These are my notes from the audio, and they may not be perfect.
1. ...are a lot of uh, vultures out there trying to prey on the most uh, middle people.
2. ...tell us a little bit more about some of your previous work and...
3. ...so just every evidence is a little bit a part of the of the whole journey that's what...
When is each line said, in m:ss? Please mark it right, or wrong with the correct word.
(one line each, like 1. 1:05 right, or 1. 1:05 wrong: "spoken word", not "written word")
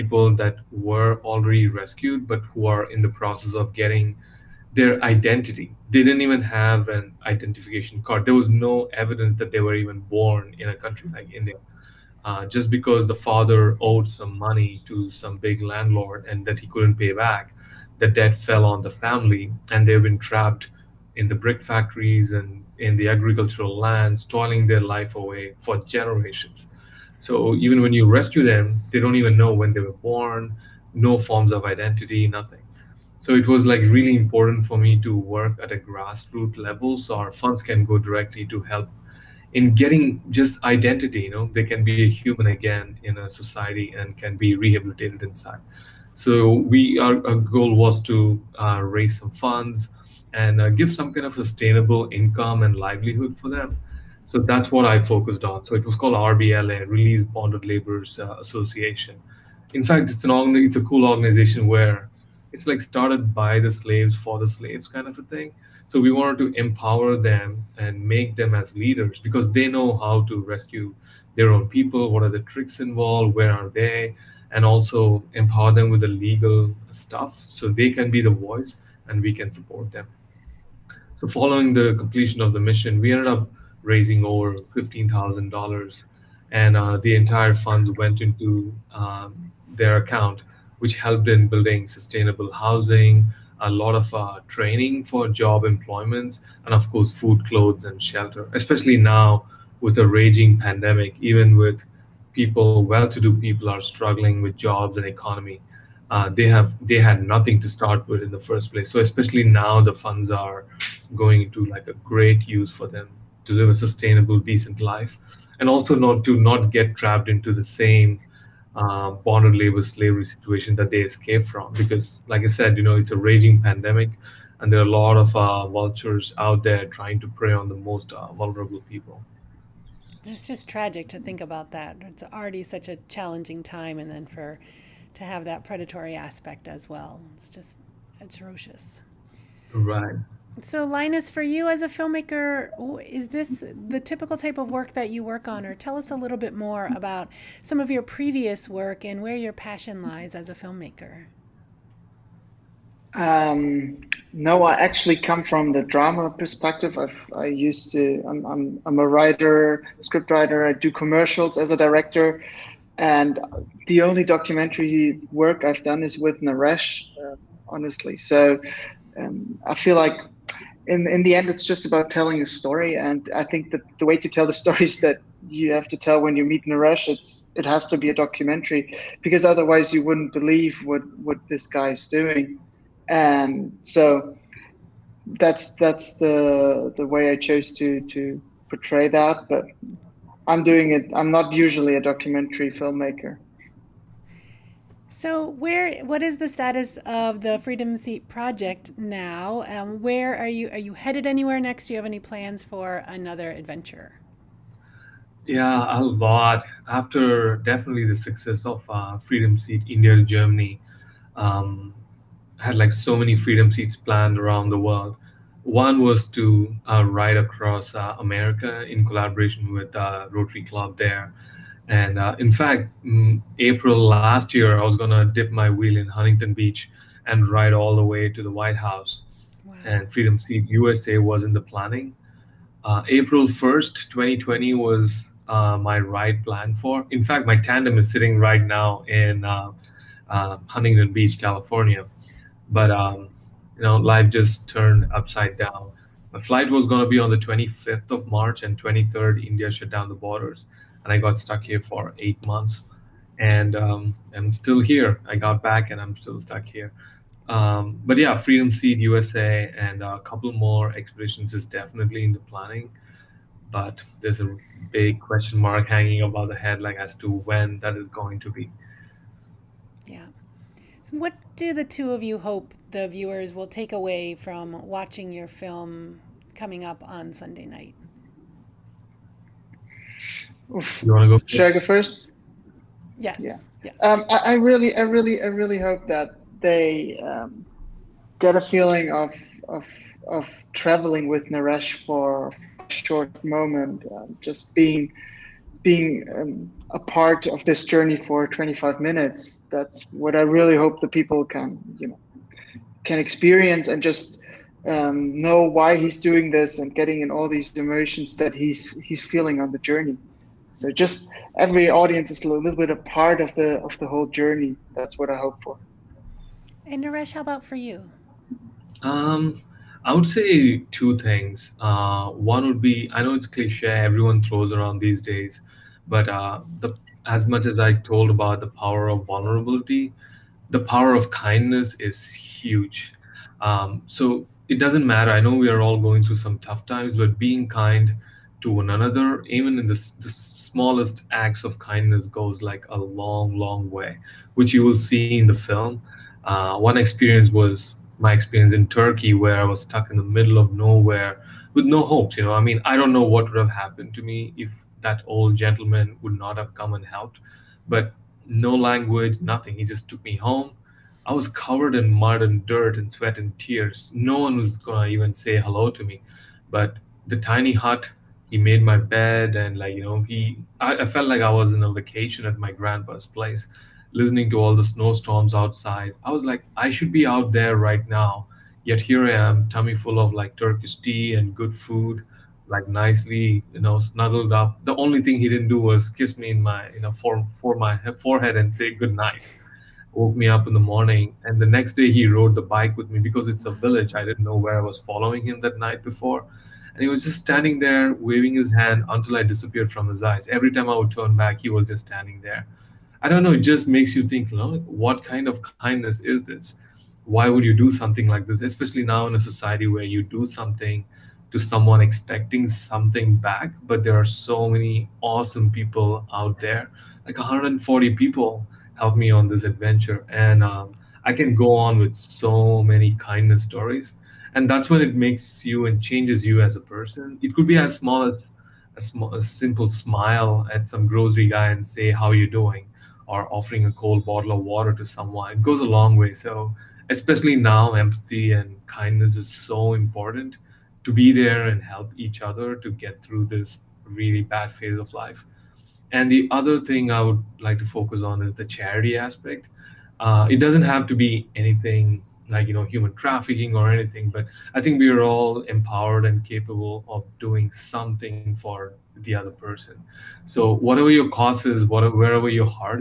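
1. 2:04 wrong: "vulnerable", not "middle"
2. 2:25 right
3. 5:10 wrong: "audience", not "evidence".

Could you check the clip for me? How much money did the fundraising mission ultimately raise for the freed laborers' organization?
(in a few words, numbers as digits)
$15,000.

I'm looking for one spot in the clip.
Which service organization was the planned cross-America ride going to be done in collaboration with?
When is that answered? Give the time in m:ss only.
3:40.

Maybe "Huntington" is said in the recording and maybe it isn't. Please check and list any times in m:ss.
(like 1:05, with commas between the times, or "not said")
3:46, 4:00.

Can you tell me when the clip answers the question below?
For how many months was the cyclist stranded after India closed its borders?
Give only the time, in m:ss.
4:12.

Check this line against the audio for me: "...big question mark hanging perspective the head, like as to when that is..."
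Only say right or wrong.
wrong.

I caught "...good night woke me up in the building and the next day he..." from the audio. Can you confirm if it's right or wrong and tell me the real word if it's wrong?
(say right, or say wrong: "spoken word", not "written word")
wrong: "morning", not "building".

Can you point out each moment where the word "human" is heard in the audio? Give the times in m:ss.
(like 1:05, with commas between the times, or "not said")
0:42, 7:32.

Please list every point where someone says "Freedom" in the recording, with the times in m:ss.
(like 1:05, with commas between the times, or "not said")
3:17, 3:29, 3:33, 3:50, 4:18.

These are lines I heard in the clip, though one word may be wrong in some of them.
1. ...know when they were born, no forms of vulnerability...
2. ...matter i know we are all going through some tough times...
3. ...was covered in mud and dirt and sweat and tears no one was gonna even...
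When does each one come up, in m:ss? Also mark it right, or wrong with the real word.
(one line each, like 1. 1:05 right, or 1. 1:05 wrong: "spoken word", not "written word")
1. 0:29 wrong: "identity", not "vulnerability"
2. 5:35 right
3. 6:01 right.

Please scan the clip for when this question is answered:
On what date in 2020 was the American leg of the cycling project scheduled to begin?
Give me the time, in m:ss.
3:53.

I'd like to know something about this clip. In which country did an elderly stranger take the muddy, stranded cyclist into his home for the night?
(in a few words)
Turkey.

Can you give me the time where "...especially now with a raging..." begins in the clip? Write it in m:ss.
1:38.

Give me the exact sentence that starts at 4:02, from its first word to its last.
But, um, you know, life just turned upside down.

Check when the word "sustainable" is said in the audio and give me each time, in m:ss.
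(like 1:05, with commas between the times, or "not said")
0:51, 1:31, 1:53.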